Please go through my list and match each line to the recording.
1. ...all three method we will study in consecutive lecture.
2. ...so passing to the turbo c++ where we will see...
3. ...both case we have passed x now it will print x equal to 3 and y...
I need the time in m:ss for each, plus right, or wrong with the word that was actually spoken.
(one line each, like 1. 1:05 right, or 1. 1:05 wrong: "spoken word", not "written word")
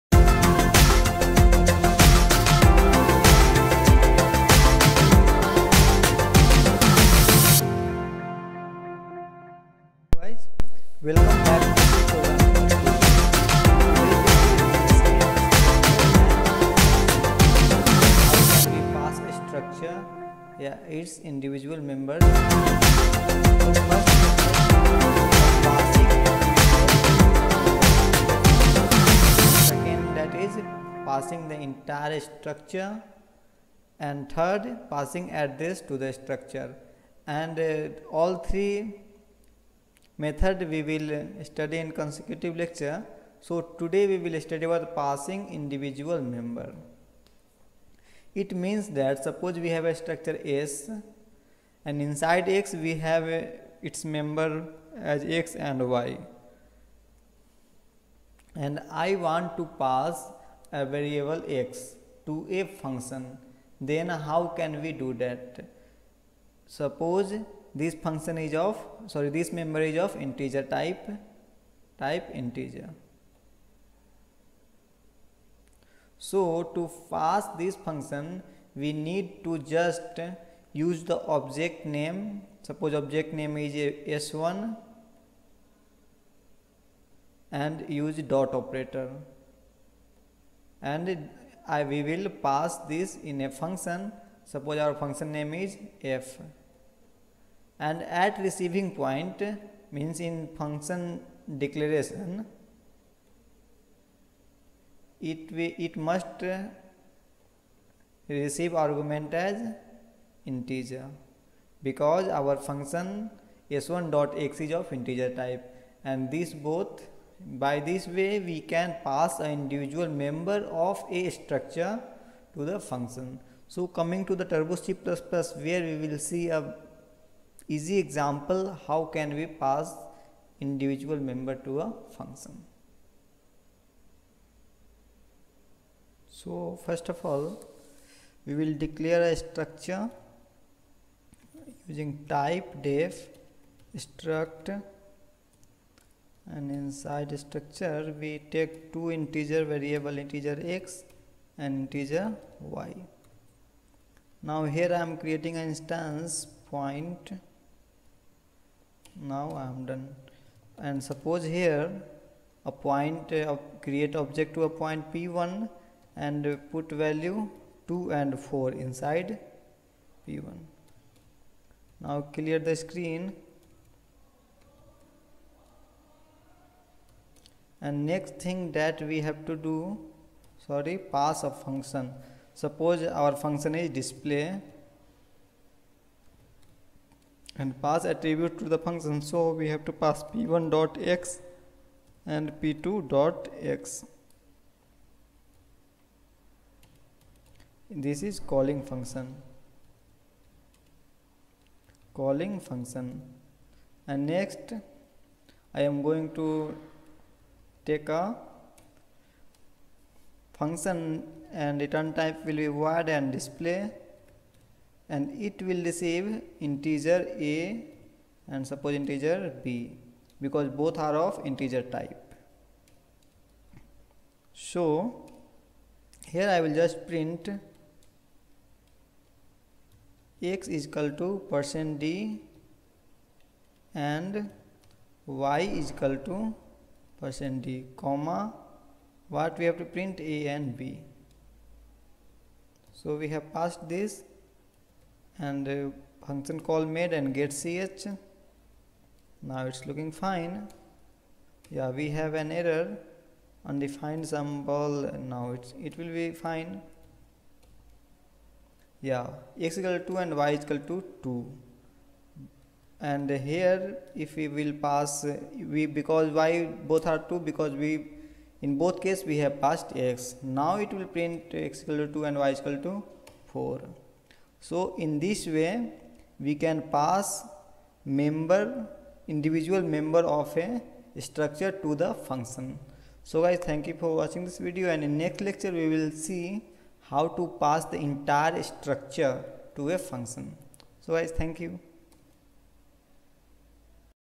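1. 0:38 right
2. 2:03 wrong: "coming", not "passing"
3. 4:28 wrong: "2", not "3".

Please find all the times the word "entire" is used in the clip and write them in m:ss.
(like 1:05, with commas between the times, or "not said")
0:31, 4:47.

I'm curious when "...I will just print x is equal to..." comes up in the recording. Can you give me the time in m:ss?
3:46.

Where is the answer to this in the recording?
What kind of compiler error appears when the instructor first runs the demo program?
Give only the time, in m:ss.
4:13.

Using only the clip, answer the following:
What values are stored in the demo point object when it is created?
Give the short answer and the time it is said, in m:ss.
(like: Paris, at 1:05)
2 and 4, at 2:47.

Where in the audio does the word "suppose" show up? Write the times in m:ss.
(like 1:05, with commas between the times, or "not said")
0:49, 1:06, 1:22, 1:34, 2:41, 3:02, 3:38.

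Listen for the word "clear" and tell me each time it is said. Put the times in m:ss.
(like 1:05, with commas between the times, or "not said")
2:52.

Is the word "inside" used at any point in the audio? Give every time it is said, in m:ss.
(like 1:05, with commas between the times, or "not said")
0:52, 2:26, 2:48.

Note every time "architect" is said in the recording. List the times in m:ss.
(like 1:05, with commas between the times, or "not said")
not said.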